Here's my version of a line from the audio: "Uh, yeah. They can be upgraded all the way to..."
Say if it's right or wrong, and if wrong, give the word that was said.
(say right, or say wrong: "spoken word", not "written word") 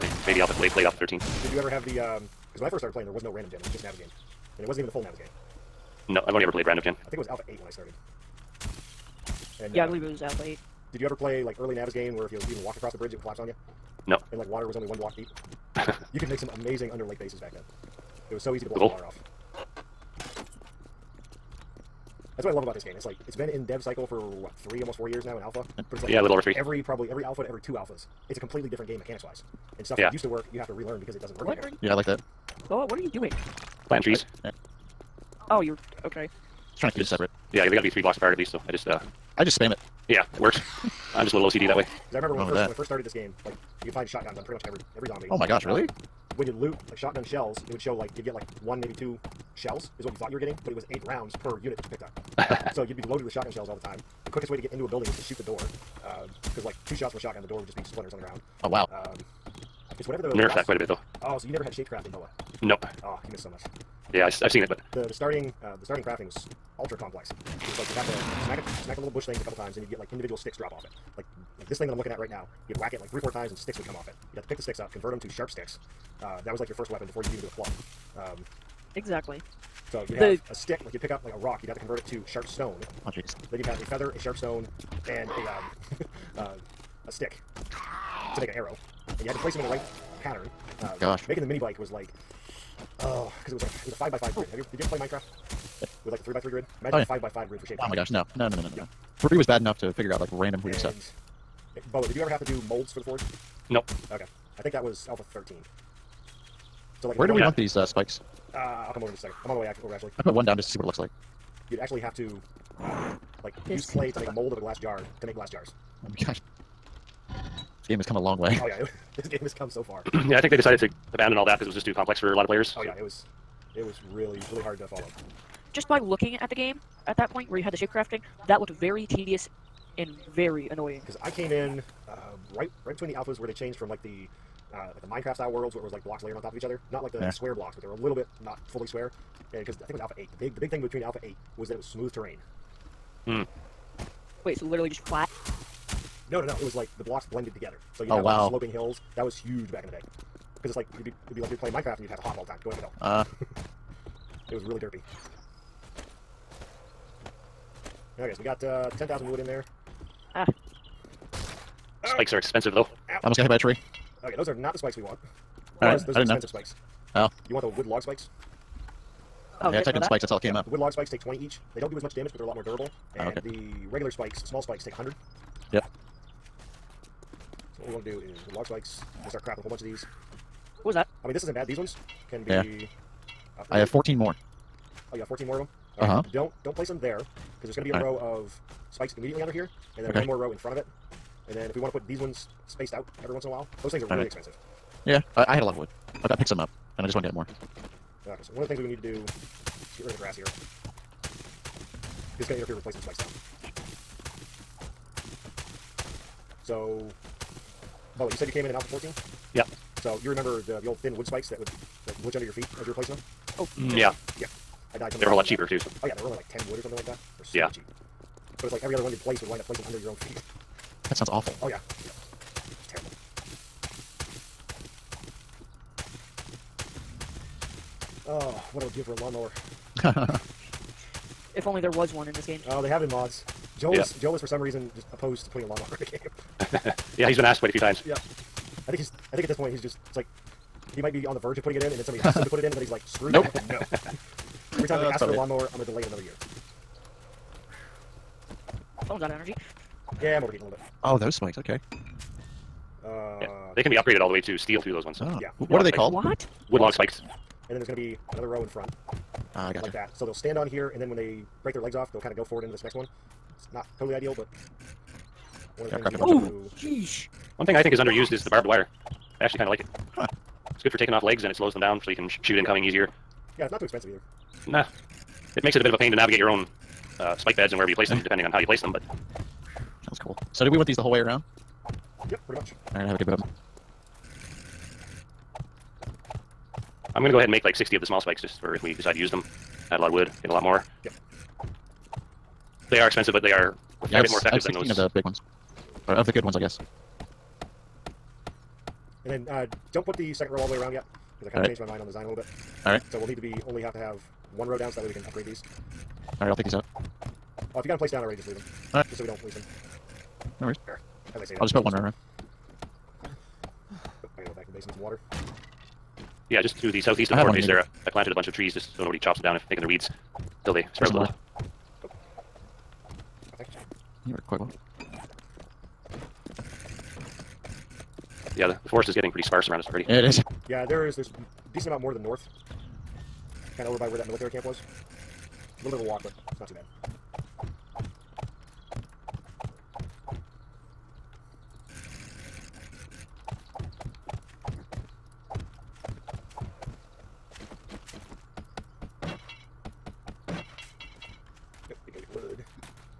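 right.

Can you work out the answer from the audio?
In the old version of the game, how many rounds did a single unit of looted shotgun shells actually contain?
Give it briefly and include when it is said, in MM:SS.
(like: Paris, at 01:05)
8, at 00:50.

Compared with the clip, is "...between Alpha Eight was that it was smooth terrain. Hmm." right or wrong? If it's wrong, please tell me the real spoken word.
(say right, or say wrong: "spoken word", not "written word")
right.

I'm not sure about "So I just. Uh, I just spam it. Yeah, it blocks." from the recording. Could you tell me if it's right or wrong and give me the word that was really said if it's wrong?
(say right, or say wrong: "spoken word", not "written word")
wrong: "works", not "blocks".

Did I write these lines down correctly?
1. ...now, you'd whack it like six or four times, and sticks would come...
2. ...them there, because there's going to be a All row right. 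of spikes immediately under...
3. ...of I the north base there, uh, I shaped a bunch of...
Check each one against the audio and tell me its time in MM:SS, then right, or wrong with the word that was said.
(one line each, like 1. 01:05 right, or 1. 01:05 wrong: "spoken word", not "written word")
1. 01:12 wrong: "three", not "six"
2. 03:06 right
3. 05:17 wrong: "planted", not "shaped".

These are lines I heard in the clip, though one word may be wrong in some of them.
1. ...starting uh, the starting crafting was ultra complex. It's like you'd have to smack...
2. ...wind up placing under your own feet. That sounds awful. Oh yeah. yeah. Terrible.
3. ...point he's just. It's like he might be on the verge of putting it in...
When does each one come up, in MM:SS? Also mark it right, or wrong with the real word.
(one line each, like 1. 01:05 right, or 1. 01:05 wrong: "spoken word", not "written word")
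1. 01:05 right
2. 03:39 right
3. 03:59 right.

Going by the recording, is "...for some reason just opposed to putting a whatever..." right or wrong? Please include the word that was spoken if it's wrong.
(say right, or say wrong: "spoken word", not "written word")
wrong: "lawnmower", not "whatever".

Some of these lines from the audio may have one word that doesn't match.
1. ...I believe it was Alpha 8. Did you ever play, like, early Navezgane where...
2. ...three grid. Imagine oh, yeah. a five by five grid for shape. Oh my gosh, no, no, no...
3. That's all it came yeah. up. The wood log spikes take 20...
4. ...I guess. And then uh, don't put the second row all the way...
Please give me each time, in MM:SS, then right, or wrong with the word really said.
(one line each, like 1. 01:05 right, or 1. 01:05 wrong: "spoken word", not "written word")
1. 00:09 right
2. 01:36 right
3. 02:50 right
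4. 04:56 right.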